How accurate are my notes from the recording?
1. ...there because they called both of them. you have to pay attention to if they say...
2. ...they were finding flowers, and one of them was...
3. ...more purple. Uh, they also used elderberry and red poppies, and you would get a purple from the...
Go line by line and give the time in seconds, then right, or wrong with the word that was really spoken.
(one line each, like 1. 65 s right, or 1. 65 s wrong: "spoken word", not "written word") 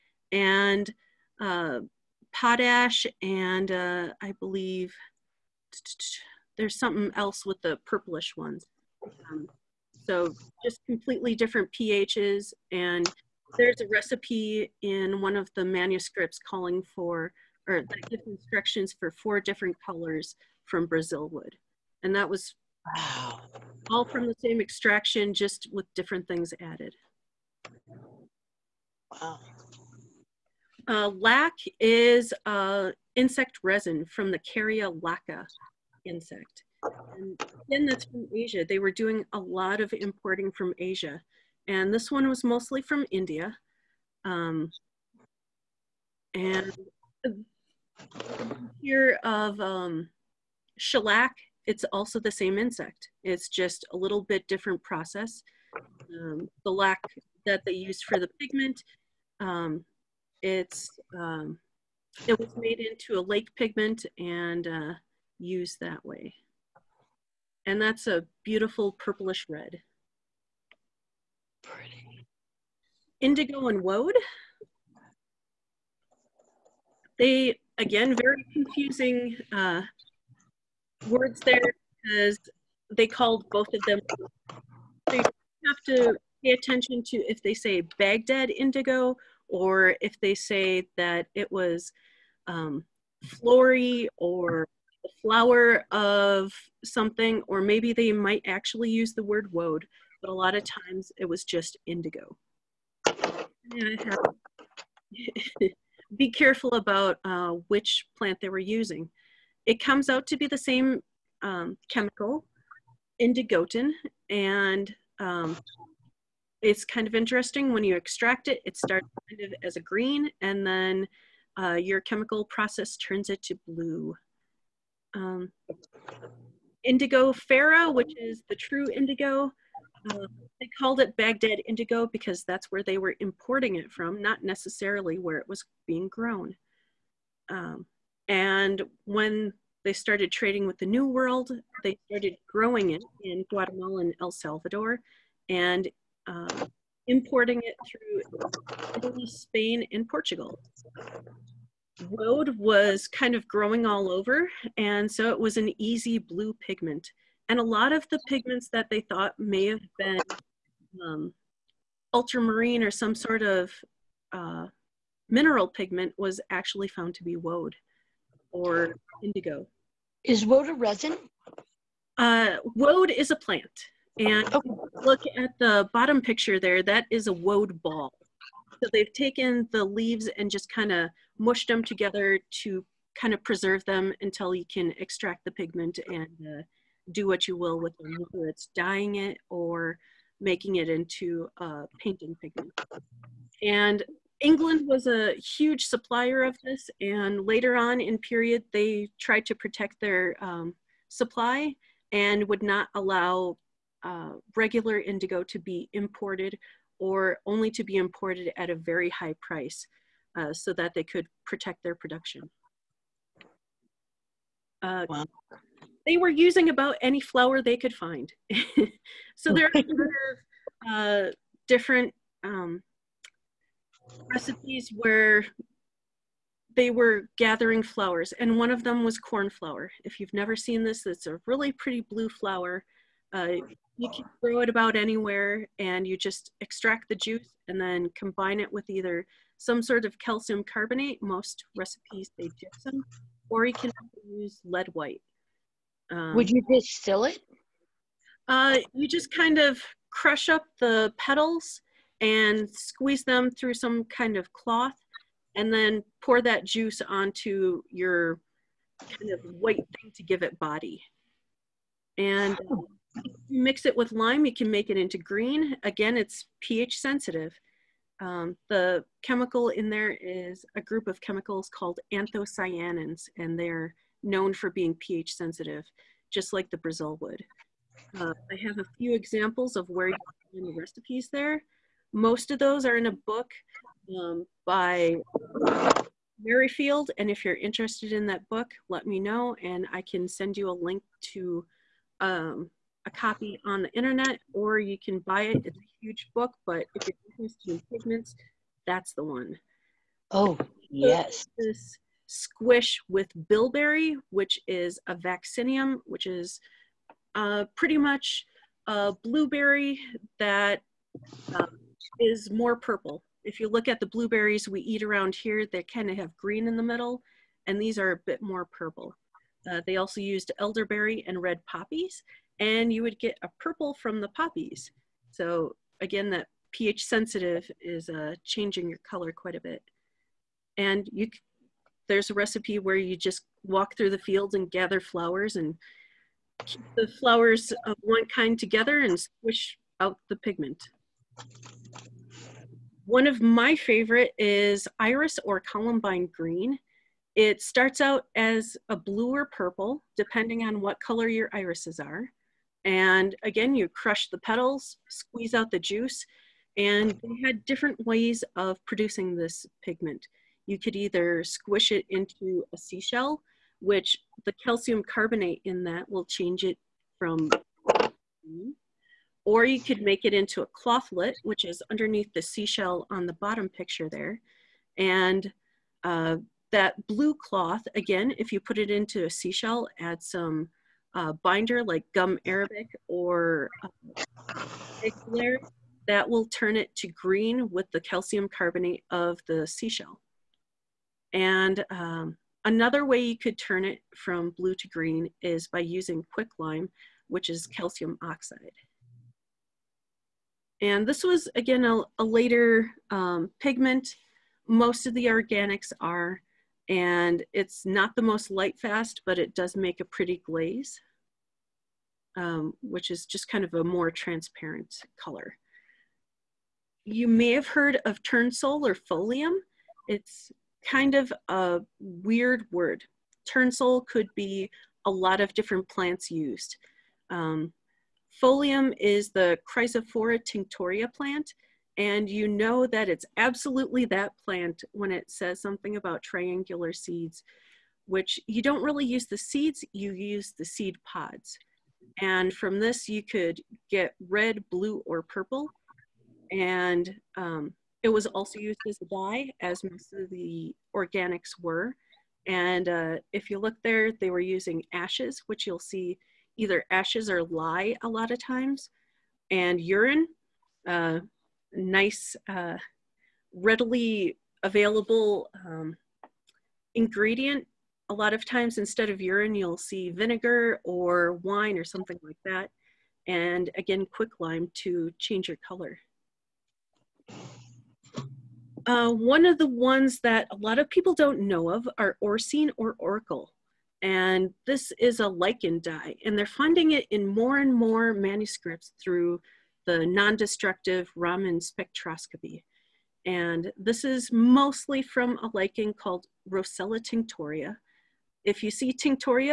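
1. 81 s right
2. 226 s wrong: "gathering", not "finding"
3. 318 s right.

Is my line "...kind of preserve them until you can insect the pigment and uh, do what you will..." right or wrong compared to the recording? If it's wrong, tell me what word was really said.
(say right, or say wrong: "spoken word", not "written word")
wrong: "extract", not "insect".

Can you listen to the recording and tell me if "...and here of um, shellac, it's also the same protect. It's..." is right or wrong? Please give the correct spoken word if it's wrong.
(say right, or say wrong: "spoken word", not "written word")
wrong: "insect", not "protect".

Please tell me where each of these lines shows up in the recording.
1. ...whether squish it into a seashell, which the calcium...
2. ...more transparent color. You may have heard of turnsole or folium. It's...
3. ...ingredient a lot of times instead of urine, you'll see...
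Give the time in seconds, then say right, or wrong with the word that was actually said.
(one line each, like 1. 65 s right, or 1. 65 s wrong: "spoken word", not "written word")
1. 360 s wrong: "either", not "whether"
2. 413 s right
3. 466 s right.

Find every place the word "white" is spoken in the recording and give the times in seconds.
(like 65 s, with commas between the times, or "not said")
244 s, 259 s.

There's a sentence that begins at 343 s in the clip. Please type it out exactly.
One of my favorite is iris or columbine green.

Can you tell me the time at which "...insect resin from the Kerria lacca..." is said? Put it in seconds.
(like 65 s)
33 s.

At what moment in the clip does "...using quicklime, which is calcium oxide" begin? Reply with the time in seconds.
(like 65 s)
395 s.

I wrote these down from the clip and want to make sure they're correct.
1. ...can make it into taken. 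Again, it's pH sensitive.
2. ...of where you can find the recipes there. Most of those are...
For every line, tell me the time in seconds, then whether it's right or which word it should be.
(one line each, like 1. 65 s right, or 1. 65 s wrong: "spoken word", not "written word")
1. 264 s wrong: "green", not "taken"
2. 279 s right.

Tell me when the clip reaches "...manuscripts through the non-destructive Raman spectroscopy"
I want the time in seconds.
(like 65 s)
488 s.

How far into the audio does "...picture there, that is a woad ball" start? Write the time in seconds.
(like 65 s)
176 s.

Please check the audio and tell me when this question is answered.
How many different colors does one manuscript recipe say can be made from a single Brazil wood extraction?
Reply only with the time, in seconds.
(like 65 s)
19 s.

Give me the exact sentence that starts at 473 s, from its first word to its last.
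And again, quicklime to change your color.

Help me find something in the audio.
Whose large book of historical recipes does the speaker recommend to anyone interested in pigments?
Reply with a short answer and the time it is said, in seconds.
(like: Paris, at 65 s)
Merrifield, at 286 s.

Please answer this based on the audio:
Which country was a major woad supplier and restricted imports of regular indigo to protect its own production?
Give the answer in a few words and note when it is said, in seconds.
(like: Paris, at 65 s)
England, at 194 s.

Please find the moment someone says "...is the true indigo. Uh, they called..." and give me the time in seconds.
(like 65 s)
128 s.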